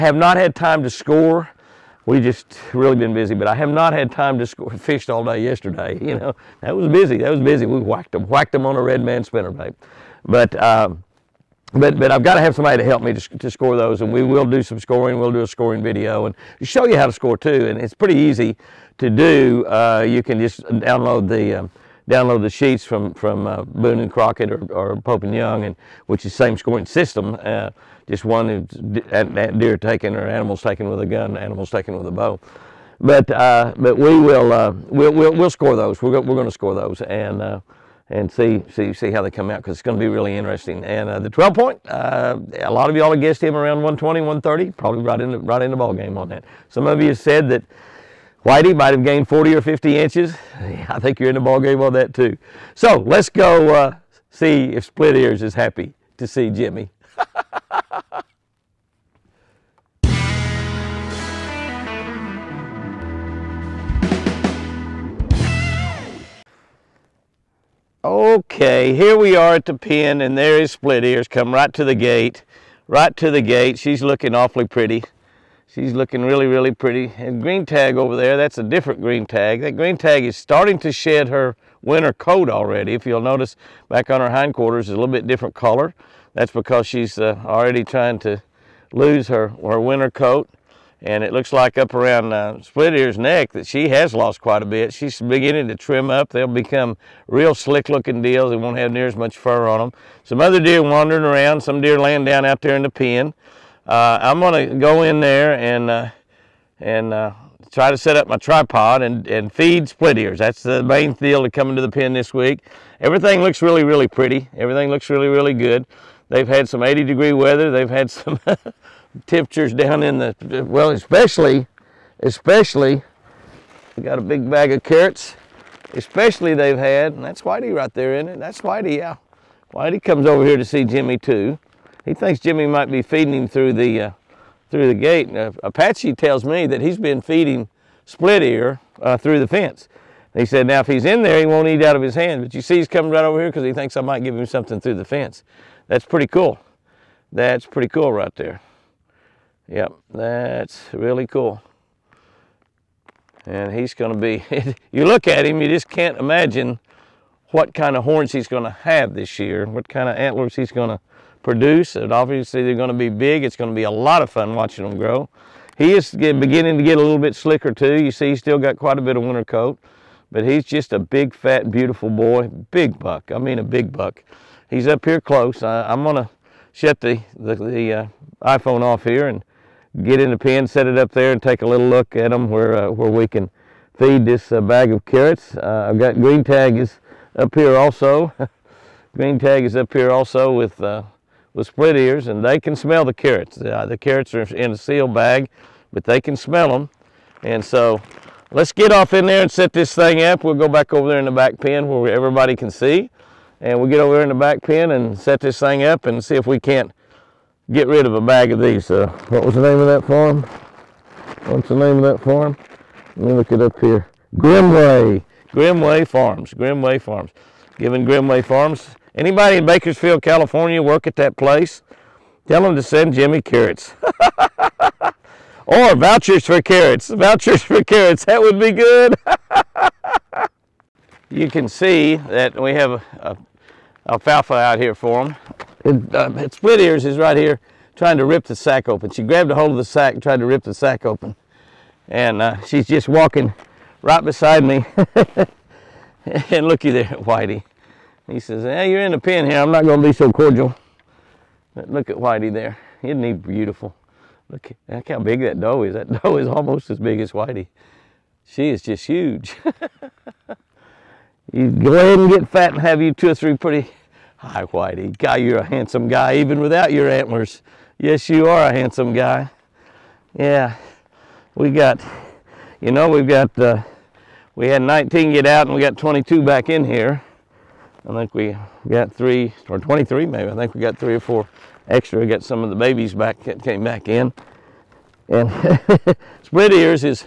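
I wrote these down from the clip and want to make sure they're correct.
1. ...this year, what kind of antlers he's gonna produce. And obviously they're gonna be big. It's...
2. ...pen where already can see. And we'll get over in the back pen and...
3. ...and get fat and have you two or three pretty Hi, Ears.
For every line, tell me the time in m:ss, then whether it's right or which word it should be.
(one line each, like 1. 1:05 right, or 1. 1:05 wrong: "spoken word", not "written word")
1. 2:39 right
2. 3:21 wrong: "everybody", not "already"
3. 4:22 wrong: "Whitey", not "Ears".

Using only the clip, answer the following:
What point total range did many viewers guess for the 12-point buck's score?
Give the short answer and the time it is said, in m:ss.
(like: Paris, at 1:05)
120, 130, at 0:43.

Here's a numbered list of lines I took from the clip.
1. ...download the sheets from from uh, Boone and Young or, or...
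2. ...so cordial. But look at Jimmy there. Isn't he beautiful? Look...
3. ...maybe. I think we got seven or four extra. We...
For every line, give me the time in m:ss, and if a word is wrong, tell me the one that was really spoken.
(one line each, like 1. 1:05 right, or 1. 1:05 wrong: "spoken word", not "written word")
1. 0:22 wrong: "Crockett", not "Young"
2. 4:10 wrong: "Whitey", not "Jimmy"
3. 4:40 wrong: "three", not "seven".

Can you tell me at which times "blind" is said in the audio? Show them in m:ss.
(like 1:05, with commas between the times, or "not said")
not said.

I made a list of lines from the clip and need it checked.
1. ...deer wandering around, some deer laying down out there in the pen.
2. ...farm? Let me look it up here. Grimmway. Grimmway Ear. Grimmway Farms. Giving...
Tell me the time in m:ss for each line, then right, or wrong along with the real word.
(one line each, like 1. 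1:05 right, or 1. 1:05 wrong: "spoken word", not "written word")
1. 1:40 right
2. 3:32 wrong: "Farms", not "Ear".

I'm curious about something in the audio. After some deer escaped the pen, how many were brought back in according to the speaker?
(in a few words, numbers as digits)
22.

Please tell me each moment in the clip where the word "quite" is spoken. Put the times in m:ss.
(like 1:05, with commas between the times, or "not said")
1:34, 2:48.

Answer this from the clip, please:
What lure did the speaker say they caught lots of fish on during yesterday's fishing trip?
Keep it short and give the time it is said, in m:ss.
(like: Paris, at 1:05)
red man spinnerbait, at 0:08.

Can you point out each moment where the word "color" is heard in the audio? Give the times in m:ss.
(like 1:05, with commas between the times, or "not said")
1:25.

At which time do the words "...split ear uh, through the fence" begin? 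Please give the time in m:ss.
2:18.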